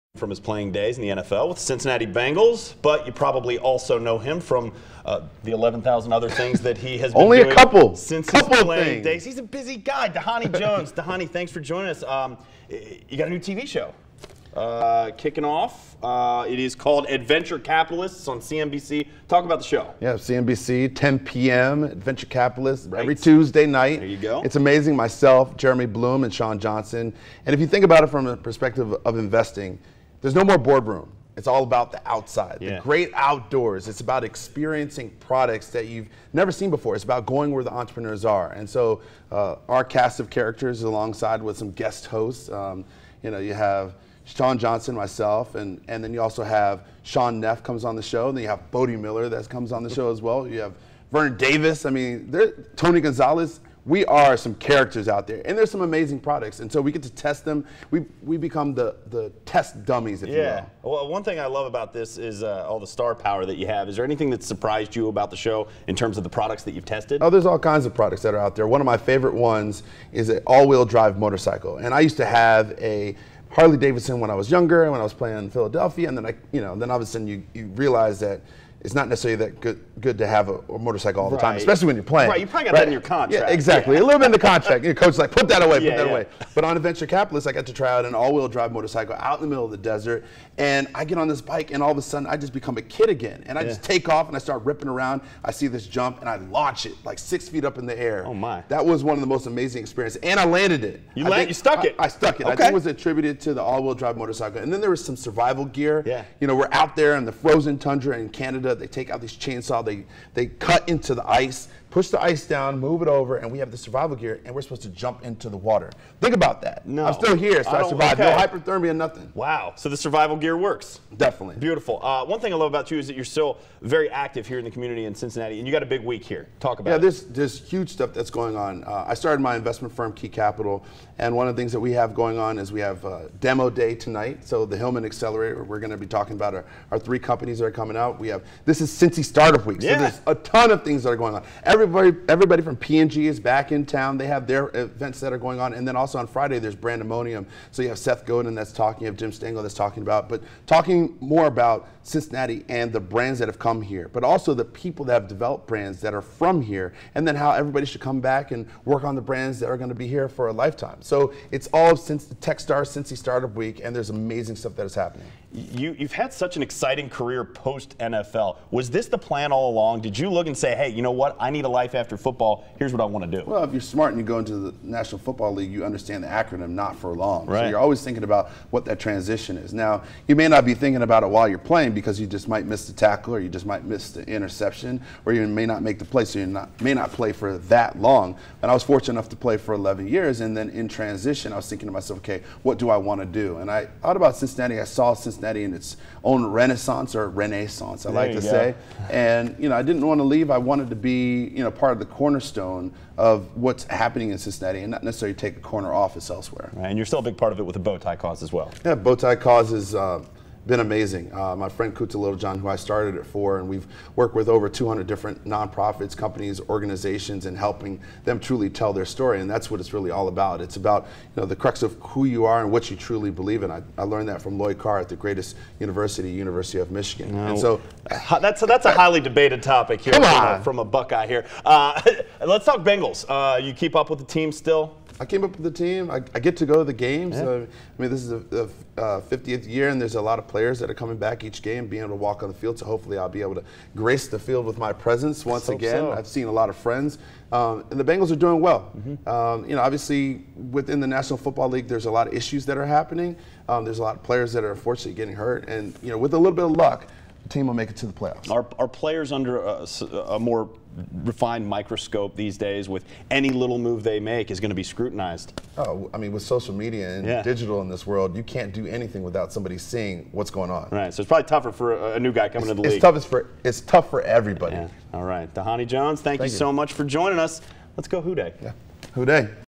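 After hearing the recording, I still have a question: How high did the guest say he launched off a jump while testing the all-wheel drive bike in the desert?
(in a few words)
6 feet.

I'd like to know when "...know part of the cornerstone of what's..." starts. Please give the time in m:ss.
3:21.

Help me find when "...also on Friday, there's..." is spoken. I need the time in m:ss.
2:25.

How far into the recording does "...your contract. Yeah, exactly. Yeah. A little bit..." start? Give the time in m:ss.
1:22.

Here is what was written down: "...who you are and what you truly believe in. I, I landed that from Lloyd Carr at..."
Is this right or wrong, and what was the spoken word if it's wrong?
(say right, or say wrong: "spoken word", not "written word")
wrong: "learned", not "landed".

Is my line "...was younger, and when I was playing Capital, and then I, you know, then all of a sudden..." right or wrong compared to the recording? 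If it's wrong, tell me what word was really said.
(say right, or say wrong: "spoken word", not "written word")
wrong: "Philadelphia", not "Capital".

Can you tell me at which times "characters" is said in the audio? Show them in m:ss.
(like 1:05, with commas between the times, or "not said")
0:40, 0:54.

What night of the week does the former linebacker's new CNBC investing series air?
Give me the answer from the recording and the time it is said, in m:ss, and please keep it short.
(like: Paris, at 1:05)
Tuesday, at 0:23.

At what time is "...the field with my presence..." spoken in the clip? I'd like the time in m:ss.
4:04.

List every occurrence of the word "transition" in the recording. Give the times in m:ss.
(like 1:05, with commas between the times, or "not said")
2:58, 3:10.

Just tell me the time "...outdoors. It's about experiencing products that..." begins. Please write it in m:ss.
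0:33.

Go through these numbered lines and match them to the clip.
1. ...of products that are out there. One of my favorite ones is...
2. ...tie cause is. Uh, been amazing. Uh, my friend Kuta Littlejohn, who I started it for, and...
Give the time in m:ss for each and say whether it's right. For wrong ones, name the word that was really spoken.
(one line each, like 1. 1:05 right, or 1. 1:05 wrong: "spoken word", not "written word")
1. 1:07 right
2. 3:29 right.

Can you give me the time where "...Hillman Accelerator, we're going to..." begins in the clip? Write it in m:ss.
2:14.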